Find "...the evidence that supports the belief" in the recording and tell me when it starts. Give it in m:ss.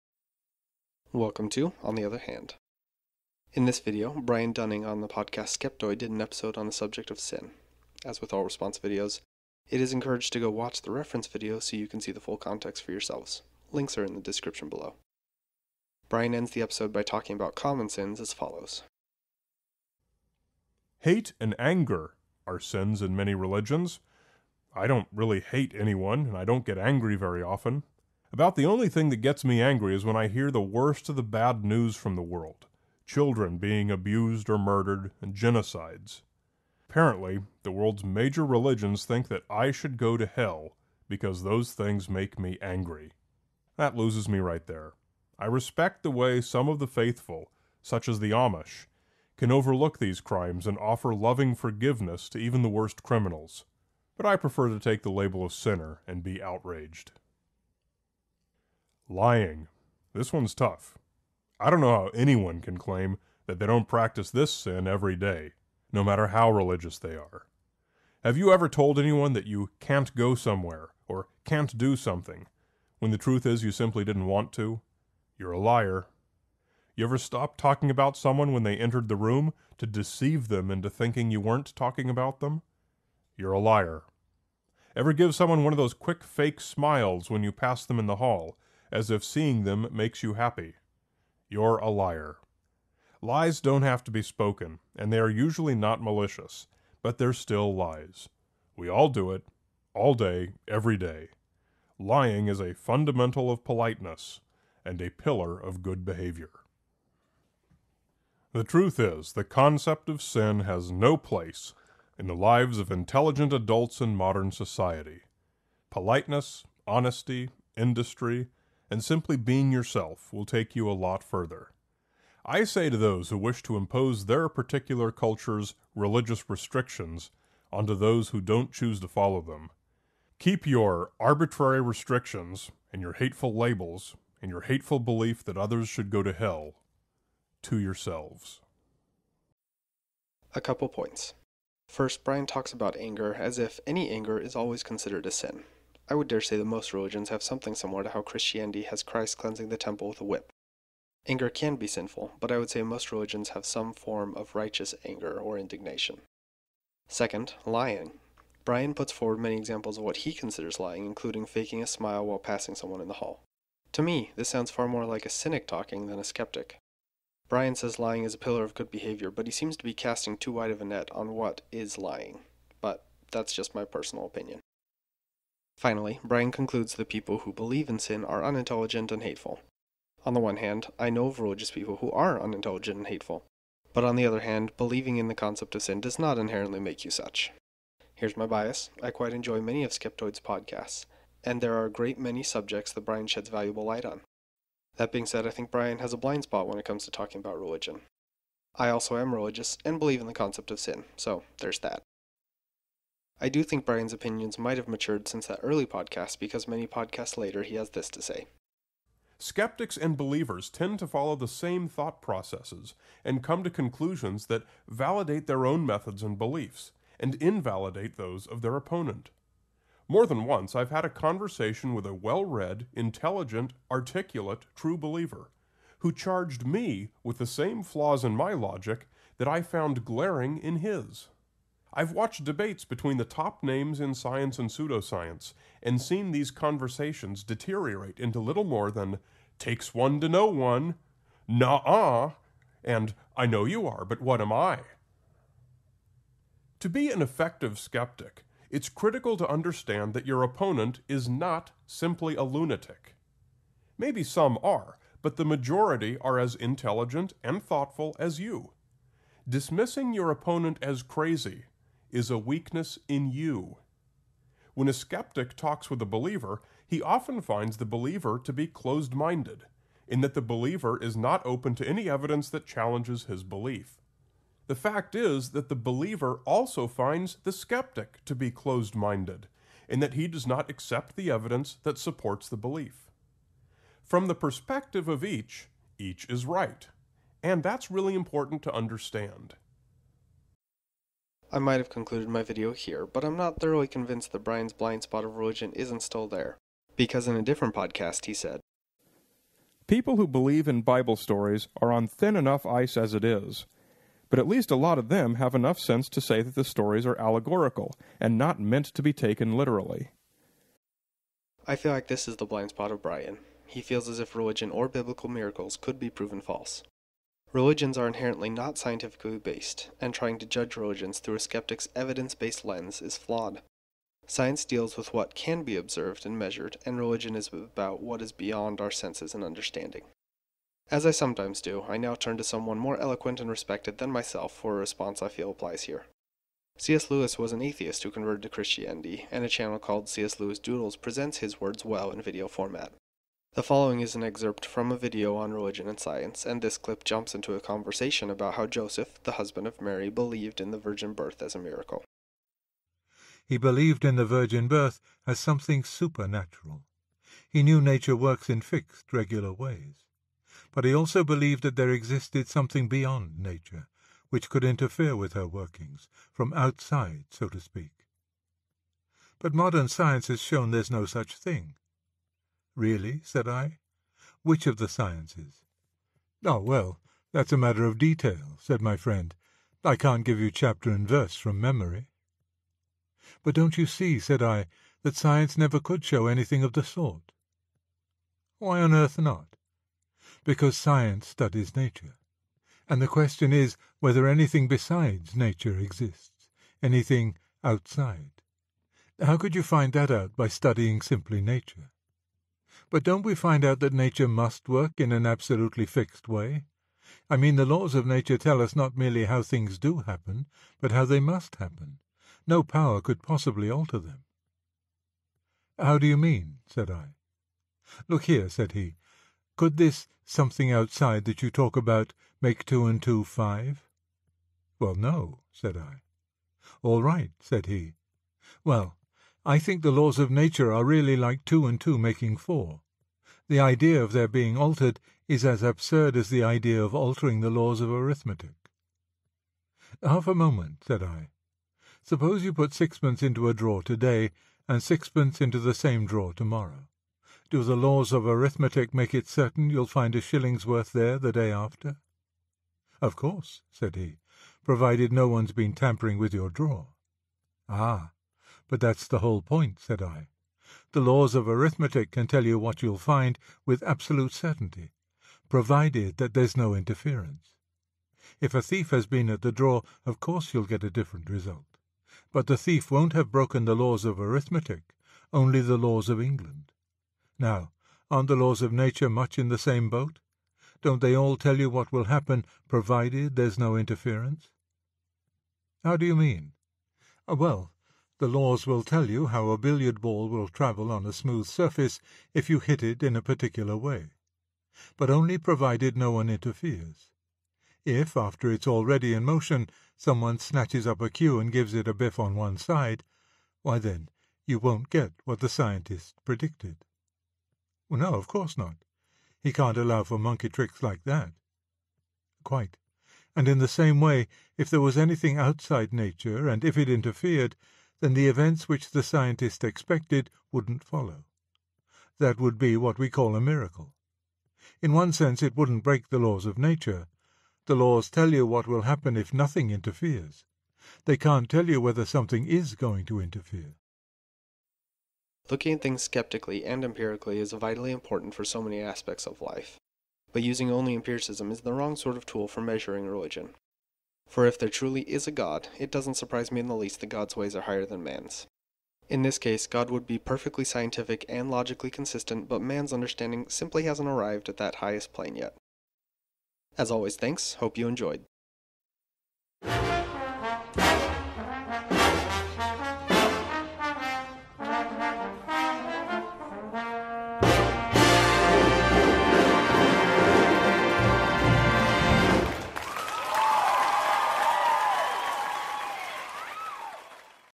4:41.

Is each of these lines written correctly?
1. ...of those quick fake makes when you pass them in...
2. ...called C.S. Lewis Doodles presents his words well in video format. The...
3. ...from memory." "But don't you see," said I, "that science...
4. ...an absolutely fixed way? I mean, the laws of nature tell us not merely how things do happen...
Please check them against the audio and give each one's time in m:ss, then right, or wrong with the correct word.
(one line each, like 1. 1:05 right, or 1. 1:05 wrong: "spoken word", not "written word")
1. 1:25 wrong: "smiles", not "makes"
2. 5:39 right
3. 6:21 right
4. 6:45 right.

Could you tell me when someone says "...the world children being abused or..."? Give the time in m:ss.
0:32.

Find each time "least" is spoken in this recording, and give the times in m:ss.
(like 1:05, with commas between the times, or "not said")
5:04, 9:06.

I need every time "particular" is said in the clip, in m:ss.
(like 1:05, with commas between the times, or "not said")
2:04, 8:13.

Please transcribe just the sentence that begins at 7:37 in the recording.
Ah, but that's the whole point, said I.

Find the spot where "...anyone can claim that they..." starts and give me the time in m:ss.
1:02.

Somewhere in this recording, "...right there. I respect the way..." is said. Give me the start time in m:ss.
0:44.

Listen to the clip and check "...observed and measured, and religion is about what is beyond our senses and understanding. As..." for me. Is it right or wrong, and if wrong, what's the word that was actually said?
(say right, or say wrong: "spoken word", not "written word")
right.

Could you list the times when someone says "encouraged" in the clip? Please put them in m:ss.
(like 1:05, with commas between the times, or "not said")
0:09.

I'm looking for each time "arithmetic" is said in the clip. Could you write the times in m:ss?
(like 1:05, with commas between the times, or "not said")
7:17, 7:28, 7:41, 7:54.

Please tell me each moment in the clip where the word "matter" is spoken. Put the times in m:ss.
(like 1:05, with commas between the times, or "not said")
1:06, 6:17.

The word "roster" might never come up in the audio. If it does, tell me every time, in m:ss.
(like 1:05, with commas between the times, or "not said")
not said.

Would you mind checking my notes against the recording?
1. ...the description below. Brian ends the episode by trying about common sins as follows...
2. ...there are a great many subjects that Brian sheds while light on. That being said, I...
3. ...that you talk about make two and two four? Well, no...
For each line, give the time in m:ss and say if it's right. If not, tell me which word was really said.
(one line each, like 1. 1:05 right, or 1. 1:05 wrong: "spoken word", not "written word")
1. 0:14 wrong: "talking", not "trying"
2. 3:11 wrong: "valuable", not "while"
3. 7:01 wrong: "five", not "four".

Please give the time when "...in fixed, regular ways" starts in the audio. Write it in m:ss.
5:58.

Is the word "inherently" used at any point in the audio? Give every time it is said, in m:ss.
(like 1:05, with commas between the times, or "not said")
3:06, 5:18.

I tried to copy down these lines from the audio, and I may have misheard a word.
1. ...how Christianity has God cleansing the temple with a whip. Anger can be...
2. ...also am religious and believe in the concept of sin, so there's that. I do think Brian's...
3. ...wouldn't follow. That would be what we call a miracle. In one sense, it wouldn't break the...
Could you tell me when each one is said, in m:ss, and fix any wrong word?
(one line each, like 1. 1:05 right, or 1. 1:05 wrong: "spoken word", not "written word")
1. 2:28 wrong: "Christ", not "God"
2. 3:18 right
3. 8:40 right.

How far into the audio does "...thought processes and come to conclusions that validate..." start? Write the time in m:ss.
3:31.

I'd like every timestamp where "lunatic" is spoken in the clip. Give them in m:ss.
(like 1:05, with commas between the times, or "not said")
4:12.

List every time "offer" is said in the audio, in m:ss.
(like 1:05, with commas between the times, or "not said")
0:50.